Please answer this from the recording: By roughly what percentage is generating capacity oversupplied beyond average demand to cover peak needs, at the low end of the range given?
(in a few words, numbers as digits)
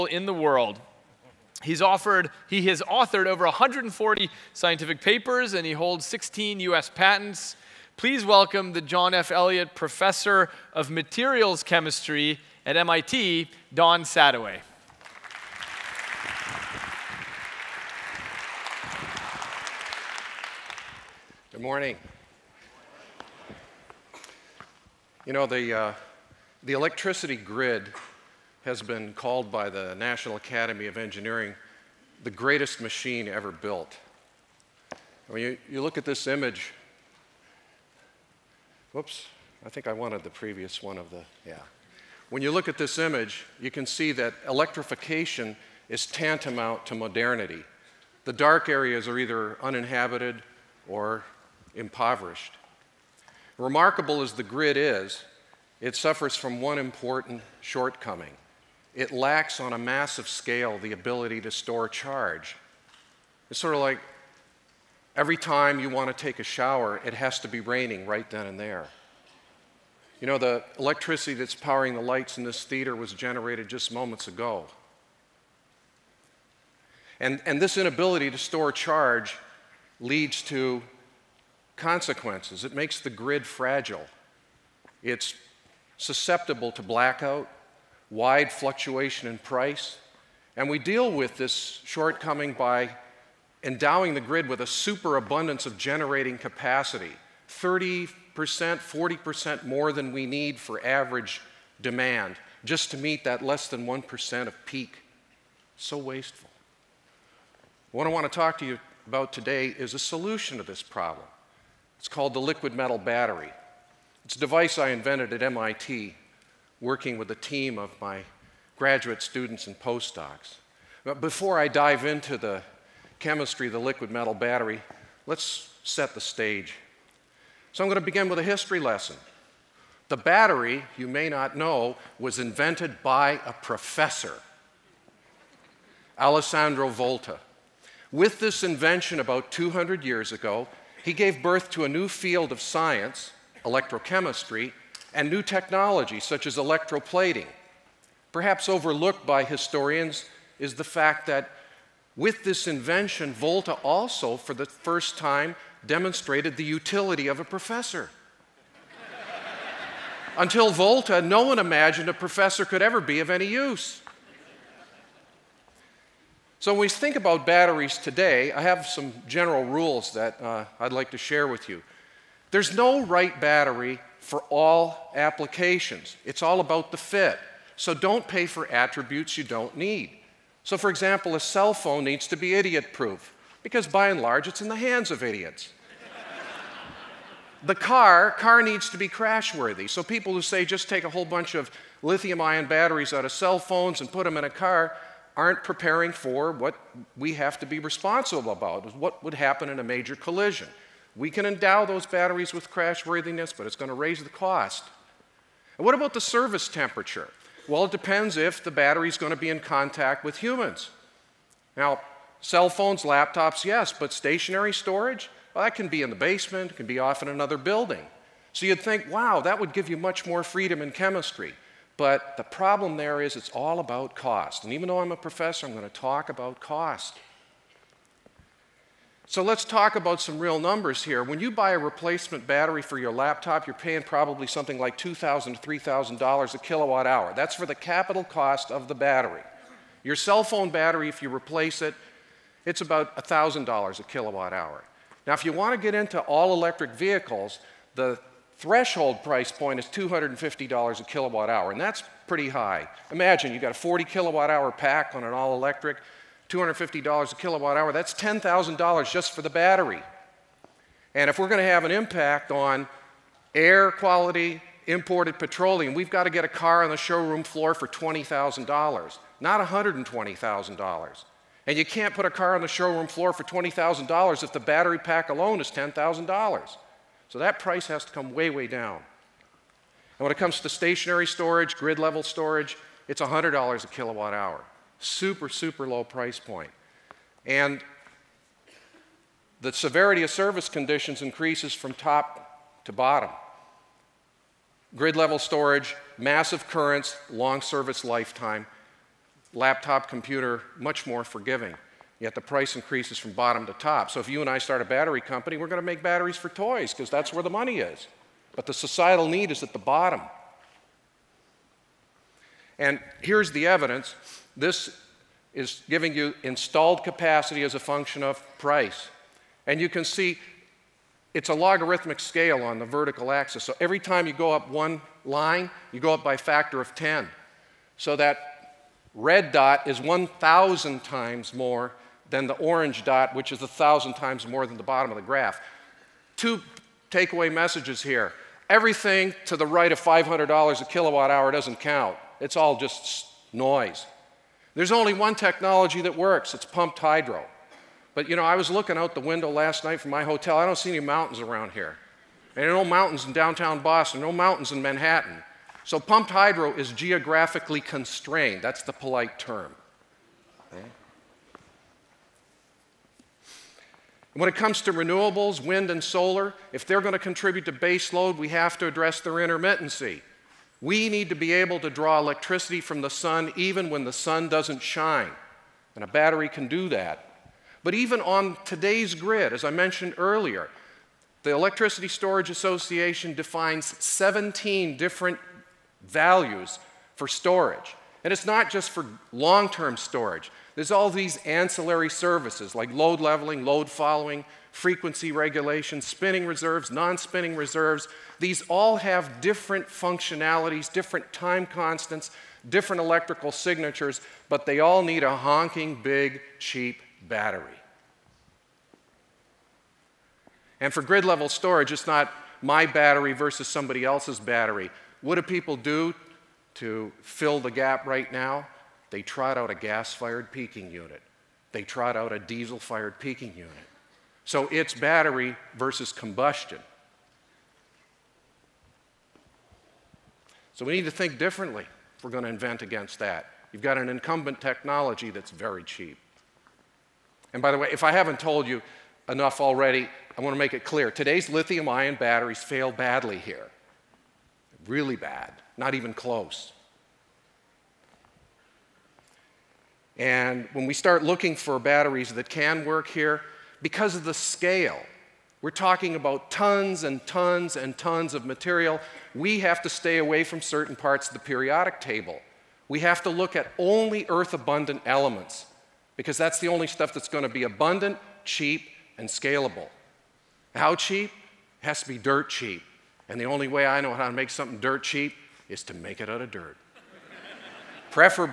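30%.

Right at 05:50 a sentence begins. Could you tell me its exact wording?
I don't see any mountains around here.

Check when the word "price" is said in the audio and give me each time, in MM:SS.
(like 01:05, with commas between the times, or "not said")
01:29, 04:09, 04:37, 04:46, 05:02, 05:18.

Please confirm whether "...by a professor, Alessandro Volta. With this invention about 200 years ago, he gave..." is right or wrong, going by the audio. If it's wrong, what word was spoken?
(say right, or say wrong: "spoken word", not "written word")
right.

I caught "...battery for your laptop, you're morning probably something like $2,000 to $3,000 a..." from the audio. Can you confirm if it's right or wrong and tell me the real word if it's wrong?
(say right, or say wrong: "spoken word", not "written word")
wrong: "paying", not "morning".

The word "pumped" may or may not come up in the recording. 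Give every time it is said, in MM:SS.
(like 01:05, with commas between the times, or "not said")
05:46, 05:55.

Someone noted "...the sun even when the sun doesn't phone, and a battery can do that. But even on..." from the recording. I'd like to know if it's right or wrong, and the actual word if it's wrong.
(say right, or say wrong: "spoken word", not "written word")
wrong: "shine", not "phone".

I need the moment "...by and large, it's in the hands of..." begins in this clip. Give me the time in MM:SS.
03:03.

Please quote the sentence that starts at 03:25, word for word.
And what about the service temperature?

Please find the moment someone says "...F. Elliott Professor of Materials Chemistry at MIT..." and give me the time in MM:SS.
00:09.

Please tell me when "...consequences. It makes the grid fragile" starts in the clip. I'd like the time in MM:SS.
01:21.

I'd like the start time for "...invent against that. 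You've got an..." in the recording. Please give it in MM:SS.
07:12.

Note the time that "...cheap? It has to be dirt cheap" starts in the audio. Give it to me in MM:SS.
07:50.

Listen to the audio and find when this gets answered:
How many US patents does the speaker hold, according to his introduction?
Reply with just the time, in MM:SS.
00:06.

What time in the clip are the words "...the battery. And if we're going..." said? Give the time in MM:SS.
04:19.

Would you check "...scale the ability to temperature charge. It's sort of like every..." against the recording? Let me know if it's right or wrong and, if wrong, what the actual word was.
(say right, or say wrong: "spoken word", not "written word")
wrong: "store", not "temperature".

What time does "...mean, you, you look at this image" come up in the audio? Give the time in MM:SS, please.
00:35.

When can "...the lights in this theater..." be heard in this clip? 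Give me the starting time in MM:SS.
01:11.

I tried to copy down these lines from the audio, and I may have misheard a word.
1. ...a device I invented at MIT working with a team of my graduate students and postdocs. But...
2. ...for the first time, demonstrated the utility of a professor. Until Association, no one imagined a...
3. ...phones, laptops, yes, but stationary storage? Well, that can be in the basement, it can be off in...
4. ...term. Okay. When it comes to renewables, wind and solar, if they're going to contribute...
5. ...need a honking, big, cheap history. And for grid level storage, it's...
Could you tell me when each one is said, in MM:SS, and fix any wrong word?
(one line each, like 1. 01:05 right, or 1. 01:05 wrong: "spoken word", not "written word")
1. 01:54 right
2. 02:34 wrong: "Volta", not "Association"
3. 03:32 right
4. 05:59 right
5. 06:45 wrong: "battery", not "history".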